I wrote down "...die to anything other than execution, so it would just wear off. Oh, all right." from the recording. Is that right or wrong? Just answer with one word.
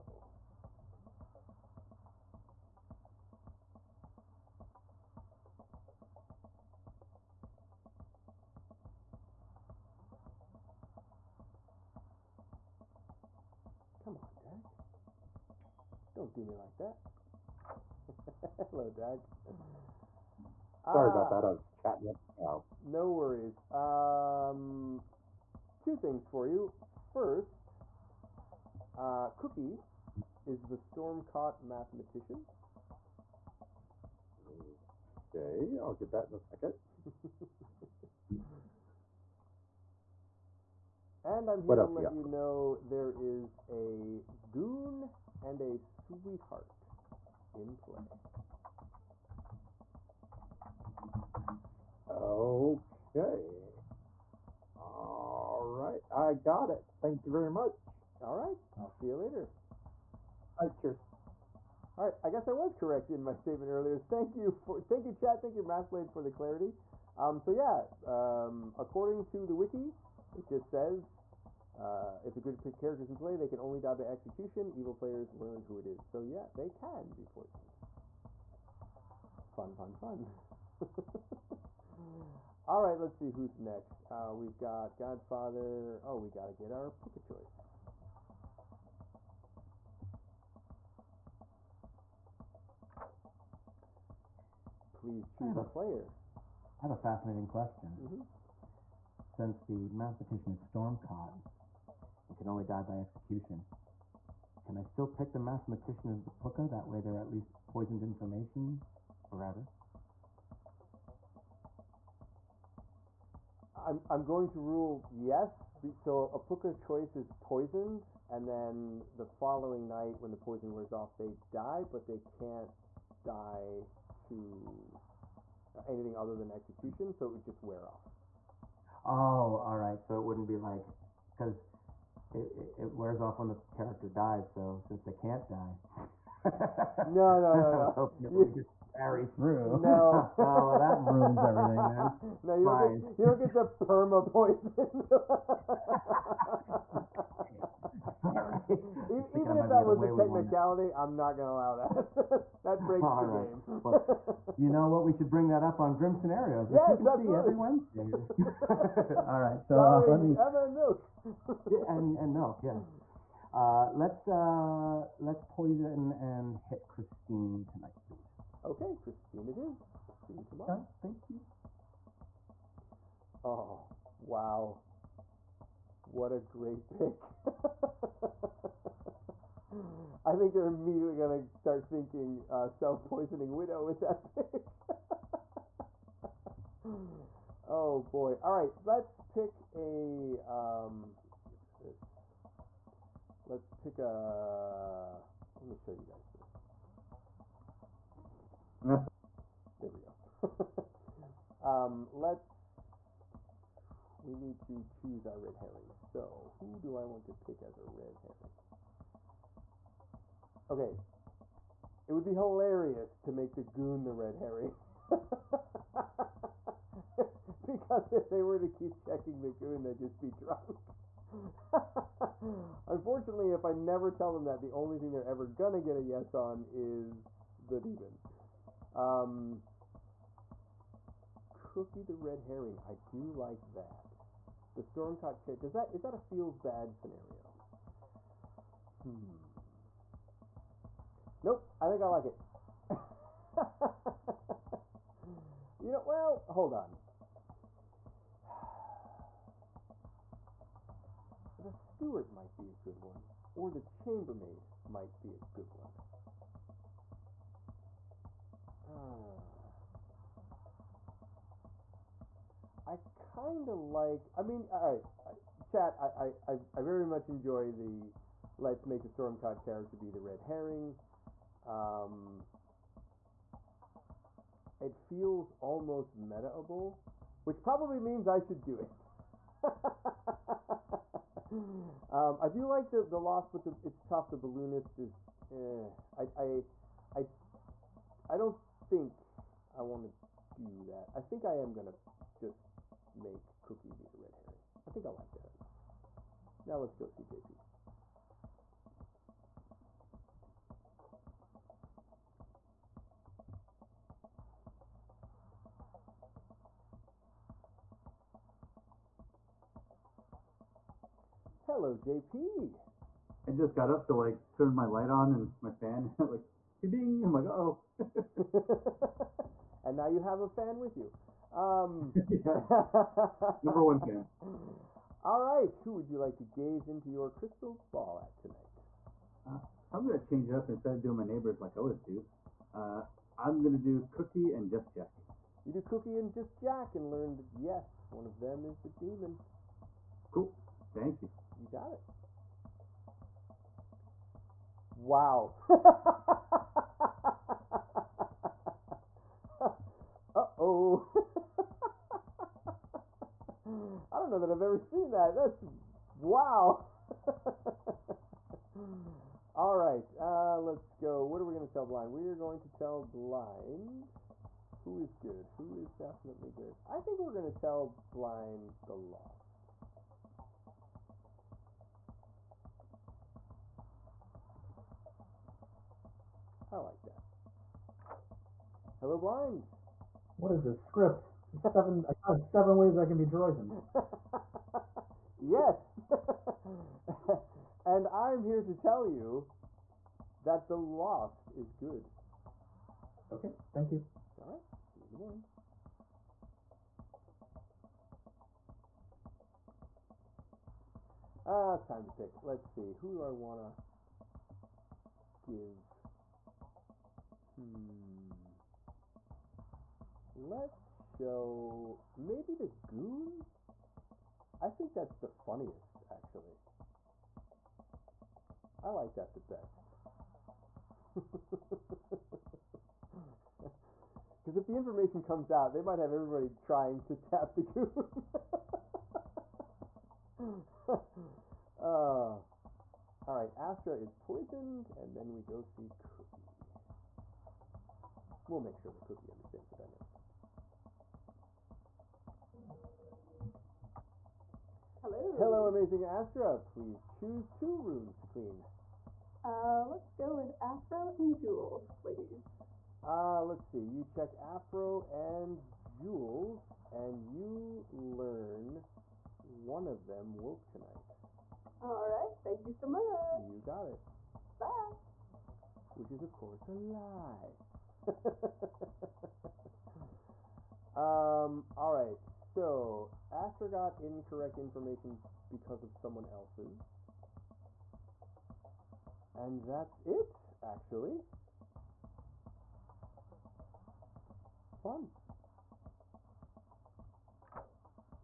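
right.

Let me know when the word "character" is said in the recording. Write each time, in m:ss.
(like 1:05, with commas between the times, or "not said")
1:12, 2:13, 3:55, 4:29.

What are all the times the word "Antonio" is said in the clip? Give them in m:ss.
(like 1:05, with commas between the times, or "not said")
not said.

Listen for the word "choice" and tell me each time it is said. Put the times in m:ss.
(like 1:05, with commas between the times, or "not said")
1:27, 1:56.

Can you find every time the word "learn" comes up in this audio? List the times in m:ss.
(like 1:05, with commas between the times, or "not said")
1:15, 5:37, 7:37.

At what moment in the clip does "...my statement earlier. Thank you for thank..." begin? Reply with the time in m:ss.
1:03.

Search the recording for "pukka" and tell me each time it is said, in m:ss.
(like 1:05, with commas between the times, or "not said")
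1:27, 1:46, 1:56.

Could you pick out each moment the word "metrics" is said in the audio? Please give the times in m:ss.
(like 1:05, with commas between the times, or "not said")
not said.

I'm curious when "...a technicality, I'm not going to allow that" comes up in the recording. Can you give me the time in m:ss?
2:30.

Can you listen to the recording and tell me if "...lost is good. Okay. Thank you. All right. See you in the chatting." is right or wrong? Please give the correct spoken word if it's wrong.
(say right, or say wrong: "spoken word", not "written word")
wrong: "morning", not "chatting".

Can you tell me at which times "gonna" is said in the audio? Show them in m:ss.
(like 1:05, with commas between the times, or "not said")
3:01, 3:45, 4:51.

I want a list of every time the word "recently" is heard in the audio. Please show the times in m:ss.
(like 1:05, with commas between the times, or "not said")
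not said.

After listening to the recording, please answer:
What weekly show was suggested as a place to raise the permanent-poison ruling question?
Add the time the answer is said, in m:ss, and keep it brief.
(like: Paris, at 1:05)
Grim Scenarios, at 2:35.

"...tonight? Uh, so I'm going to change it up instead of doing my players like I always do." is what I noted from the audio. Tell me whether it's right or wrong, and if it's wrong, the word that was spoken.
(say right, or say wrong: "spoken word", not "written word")
wrong: "neighbors", not "players".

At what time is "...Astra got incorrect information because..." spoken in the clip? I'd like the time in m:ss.
7:53.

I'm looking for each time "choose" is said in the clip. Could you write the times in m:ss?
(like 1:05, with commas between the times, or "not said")
1:35, 3:24, 7:27.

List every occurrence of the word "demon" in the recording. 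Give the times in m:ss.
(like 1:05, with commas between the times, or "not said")
3:47, 5:39.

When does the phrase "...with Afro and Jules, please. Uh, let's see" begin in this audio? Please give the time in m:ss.
7:30.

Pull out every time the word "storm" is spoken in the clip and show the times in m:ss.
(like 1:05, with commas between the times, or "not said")
0:30, 1:40, 3:54, 4:29.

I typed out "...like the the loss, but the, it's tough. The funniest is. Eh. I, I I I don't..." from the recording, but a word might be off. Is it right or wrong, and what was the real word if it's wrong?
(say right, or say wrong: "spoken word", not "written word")
wrong: "balloonist", not "funniest".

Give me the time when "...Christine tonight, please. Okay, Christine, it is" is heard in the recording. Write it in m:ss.
2:46.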